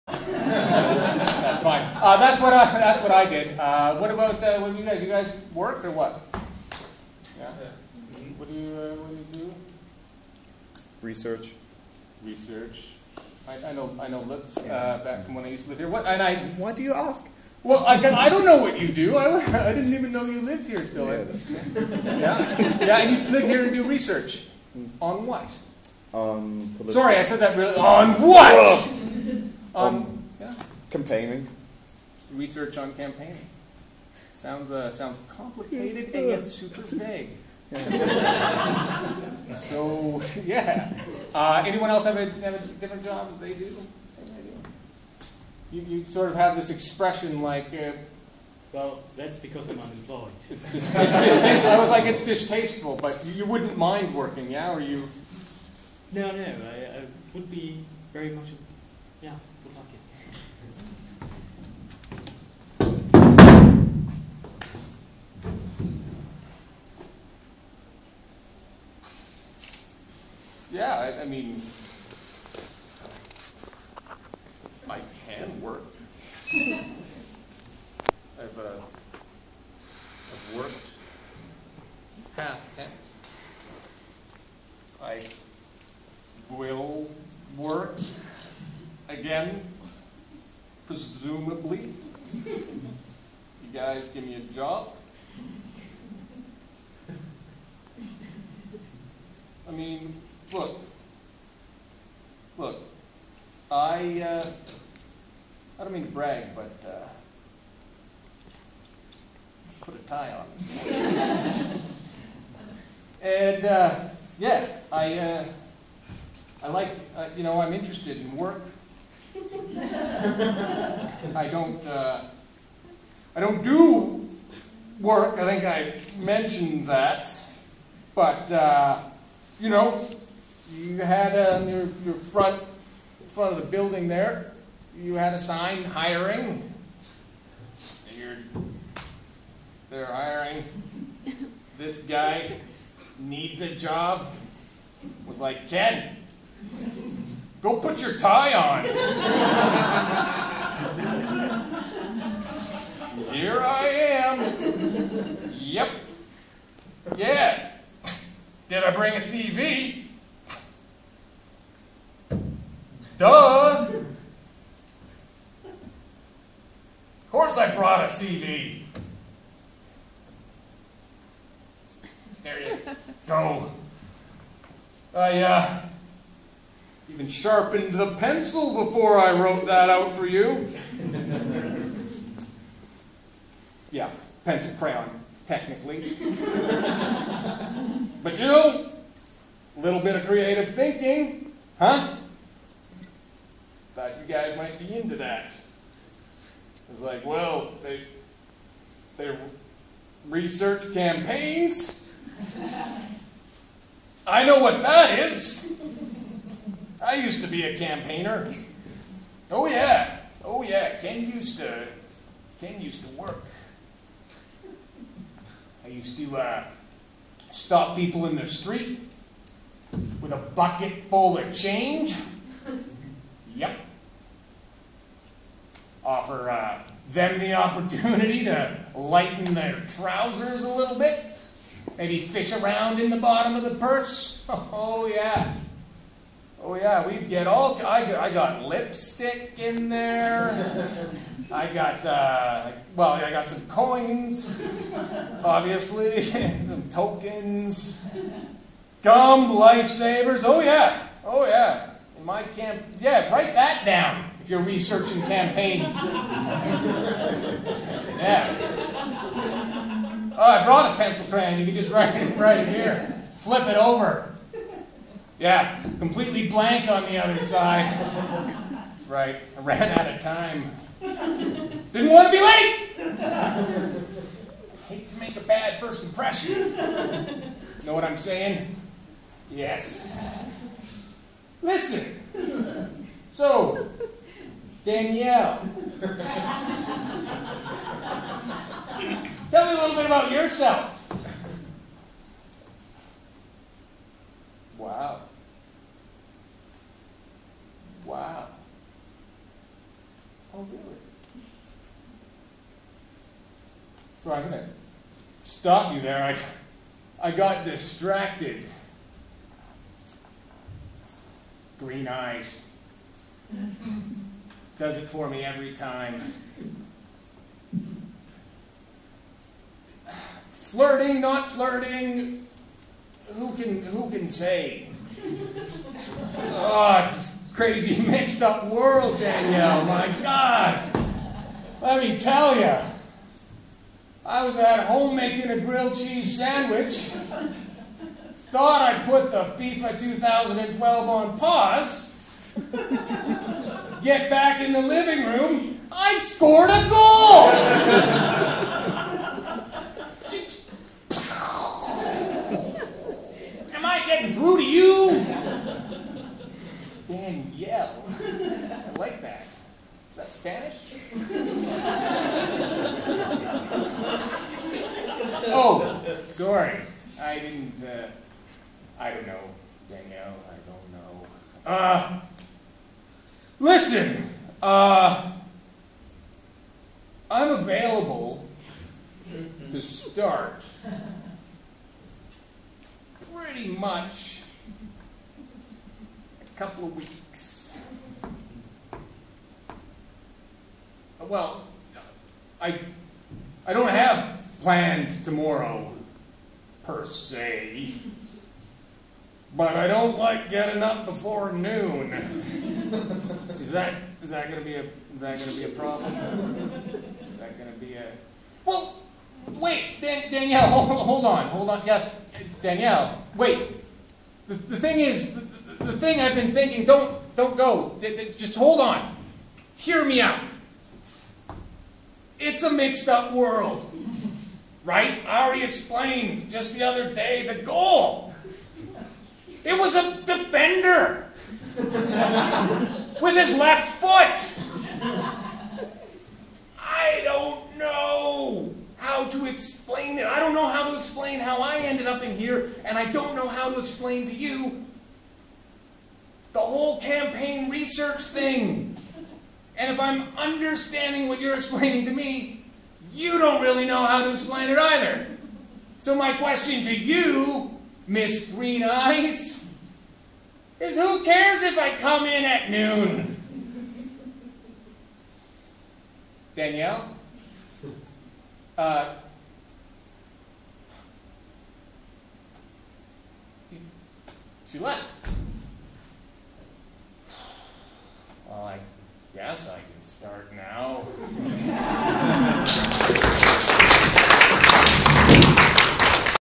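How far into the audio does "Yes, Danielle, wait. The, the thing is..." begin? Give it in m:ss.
6:51.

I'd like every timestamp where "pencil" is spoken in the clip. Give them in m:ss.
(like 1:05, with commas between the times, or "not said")
2:58, 3:04, 4:20.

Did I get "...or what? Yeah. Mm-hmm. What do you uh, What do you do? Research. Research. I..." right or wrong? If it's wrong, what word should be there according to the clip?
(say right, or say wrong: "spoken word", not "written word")
right.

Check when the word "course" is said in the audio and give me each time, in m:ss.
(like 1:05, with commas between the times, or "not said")
2:47.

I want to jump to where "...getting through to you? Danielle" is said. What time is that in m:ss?
5:54.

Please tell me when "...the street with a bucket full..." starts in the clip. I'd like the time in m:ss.
3:38.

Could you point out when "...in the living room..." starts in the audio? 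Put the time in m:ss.
5:44.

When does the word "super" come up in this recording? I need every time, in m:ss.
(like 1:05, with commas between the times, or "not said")
0:36.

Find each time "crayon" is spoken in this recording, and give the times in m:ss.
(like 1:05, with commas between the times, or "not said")
3:04, 4:21.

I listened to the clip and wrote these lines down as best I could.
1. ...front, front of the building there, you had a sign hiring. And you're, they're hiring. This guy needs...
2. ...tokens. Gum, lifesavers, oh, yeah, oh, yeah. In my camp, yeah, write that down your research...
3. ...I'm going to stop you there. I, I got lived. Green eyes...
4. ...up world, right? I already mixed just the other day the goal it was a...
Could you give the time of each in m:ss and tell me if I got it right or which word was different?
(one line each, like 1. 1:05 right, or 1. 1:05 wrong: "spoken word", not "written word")
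1. 2:12 right
2. 4:06 right
3. 5:04 wrong: "distracted", not "lived"
4. 7:03 wrong: "explained", not "mixed".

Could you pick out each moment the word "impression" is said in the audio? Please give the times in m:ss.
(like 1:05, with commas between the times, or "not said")
4:36.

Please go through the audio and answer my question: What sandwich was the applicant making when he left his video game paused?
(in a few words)
Grilled cheese.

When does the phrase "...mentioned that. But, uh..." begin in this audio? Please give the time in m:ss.
2:06.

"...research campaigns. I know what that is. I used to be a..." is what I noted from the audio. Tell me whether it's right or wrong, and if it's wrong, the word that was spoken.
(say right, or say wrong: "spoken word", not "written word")
right.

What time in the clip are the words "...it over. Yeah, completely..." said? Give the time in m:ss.
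4:23.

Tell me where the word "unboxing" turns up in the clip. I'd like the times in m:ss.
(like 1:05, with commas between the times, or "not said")
not said.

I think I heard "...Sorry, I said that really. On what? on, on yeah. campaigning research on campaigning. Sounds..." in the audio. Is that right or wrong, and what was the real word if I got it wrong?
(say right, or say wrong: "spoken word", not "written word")
right.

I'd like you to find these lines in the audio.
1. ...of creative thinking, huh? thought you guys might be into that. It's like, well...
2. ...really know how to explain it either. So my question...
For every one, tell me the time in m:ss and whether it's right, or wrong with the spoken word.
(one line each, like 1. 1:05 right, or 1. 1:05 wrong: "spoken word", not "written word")
1. 3:10 right
2. 7:33 right.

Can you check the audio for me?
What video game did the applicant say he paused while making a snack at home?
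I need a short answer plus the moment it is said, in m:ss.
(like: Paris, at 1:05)
FIFA 2012, at 5:39.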